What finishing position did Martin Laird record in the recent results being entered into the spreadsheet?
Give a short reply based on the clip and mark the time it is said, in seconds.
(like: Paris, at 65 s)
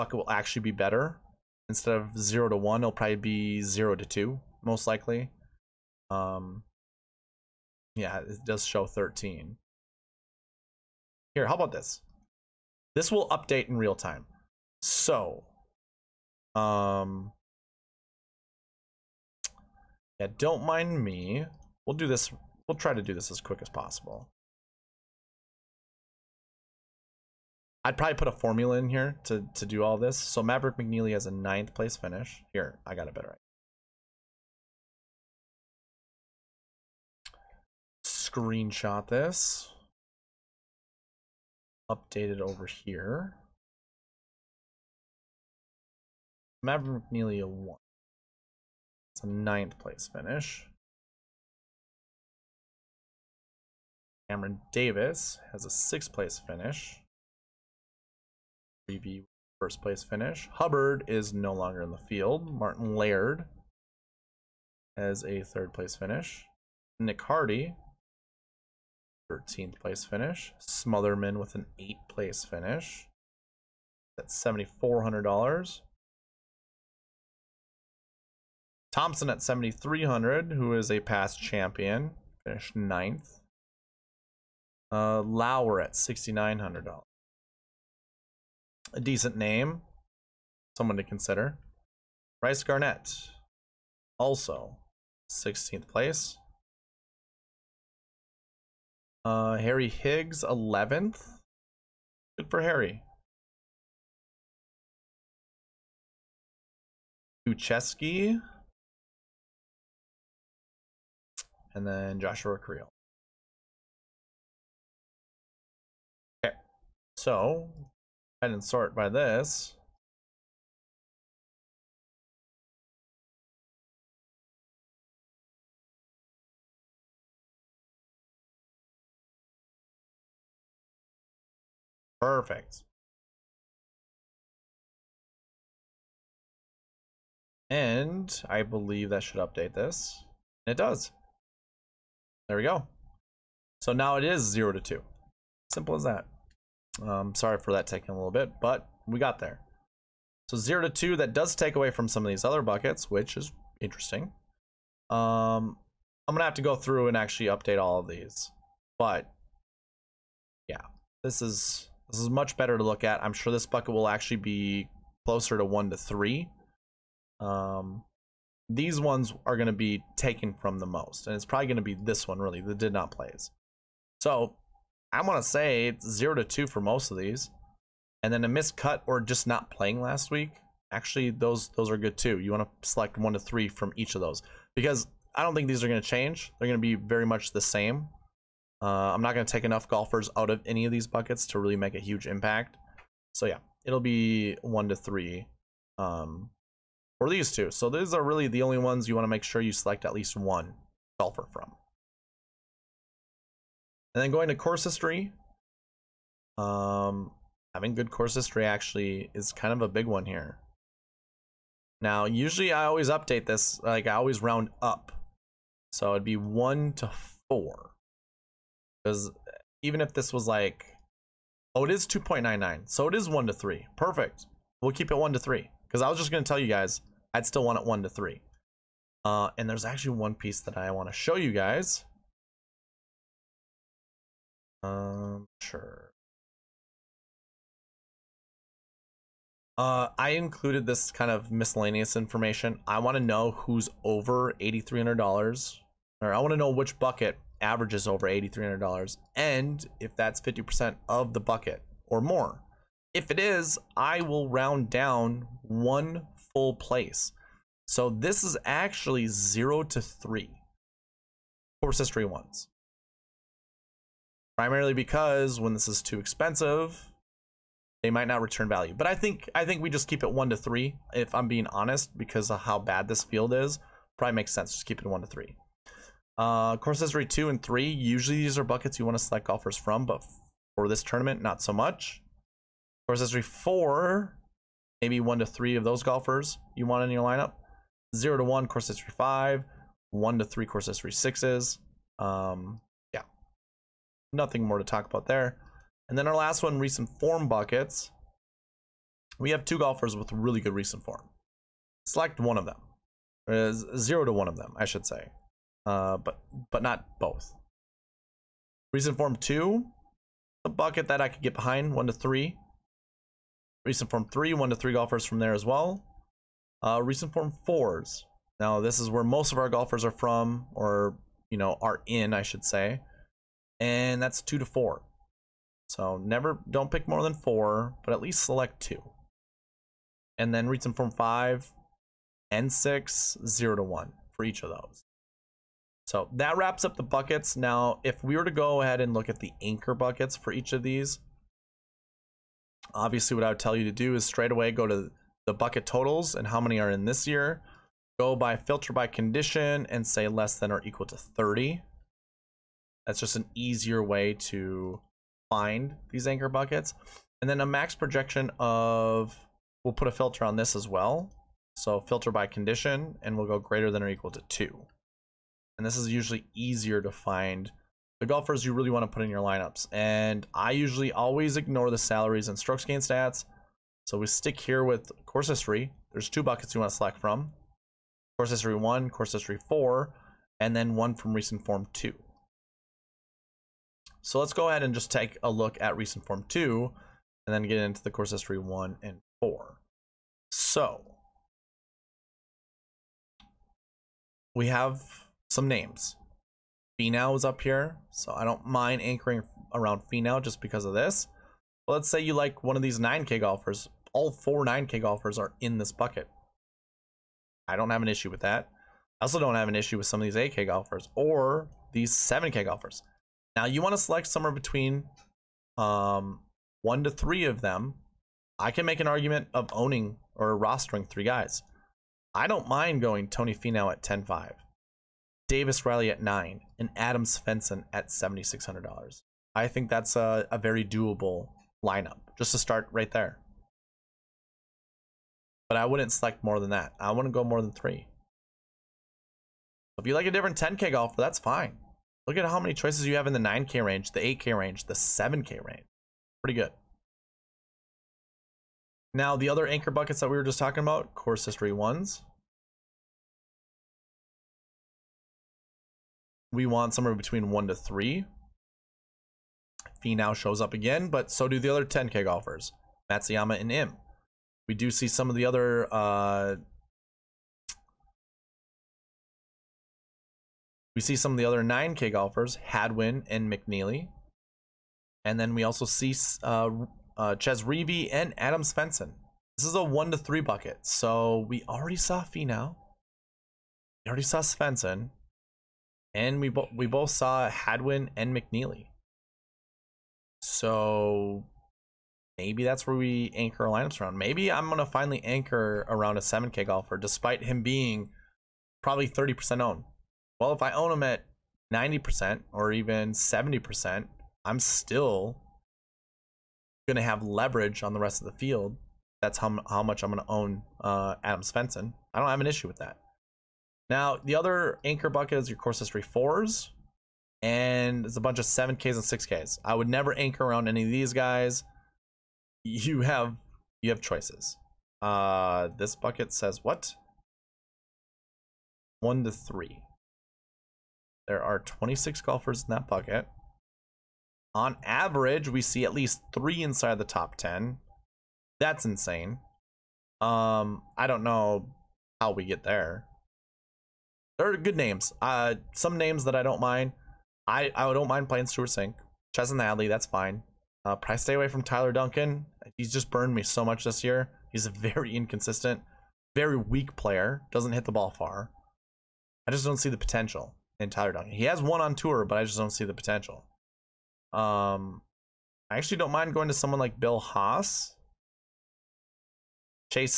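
3rd, at 65 s.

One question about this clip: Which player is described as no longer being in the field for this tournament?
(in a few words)
Hubbard.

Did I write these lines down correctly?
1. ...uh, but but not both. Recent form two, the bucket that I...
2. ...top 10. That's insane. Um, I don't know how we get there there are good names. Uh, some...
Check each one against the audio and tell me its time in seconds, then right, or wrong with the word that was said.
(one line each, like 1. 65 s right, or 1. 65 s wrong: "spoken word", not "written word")
1. 305 s right
2. 537 s right.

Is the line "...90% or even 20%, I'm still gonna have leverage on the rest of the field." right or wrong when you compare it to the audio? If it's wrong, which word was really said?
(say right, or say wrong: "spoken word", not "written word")
wrong: "70", not "20".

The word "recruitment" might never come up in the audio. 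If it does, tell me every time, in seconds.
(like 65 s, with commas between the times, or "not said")
not said.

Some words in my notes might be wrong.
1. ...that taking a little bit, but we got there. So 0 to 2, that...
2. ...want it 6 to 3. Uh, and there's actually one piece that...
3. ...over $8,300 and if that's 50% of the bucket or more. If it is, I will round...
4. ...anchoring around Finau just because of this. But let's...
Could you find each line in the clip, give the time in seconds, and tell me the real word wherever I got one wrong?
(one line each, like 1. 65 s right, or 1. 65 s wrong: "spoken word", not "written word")
1. 147 s right
2. 227 s wrong: "1", not "6"
3. 248 s right
4. 399 s right.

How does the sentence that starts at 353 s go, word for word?
That's just an easier way to find these anchor buckets.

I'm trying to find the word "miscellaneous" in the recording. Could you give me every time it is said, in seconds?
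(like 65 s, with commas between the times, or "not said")
241 s.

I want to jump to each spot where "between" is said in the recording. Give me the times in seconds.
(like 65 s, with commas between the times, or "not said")
414 s, 457 s.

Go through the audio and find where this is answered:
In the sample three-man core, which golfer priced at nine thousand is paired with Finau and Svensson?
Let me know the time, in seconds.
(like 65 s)
425 s.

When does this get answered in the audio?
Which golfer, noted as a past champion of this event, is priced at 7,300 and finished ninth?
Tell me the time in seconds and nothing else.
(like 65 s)
78 s.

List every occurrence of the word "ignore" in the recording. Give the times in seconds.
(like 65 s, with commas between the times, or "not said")
371 s.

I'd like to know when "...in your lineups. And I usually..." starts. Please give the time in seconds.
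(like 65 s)
369 s.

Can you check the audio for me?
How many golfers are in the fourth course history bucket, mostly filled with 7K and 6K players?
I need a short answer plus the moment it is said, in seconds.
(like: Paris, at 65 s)
26, at 531 s.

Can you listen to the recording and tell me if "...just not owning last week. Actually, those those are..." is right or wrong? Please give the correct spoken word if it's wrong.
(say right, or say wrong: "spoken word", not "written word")
wrong: "playing", not "owning".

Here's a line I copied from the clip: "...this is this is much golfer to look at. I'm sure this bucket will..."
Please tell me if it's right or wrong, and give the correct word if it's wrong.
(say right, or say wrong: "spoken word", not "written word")
wrong: "better", not "golfer".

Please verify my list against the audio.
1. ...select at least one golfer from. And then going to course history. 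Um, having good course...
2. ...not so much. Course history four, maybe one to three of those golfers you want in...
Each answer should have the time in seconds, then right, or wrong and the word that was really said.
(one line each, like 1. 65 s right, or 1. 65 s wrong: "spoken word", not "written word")
1. 199 s right
2. 281 s right.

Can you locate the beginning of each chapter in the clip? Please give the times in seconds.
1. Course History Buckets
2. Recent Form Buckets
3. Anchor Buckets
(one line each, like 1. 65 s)
1. 204 s
2. 296 s
3. 339 s.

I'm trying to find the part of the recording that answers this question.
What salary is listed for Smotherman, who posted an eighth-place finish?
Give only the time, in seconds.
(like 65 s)
74 s.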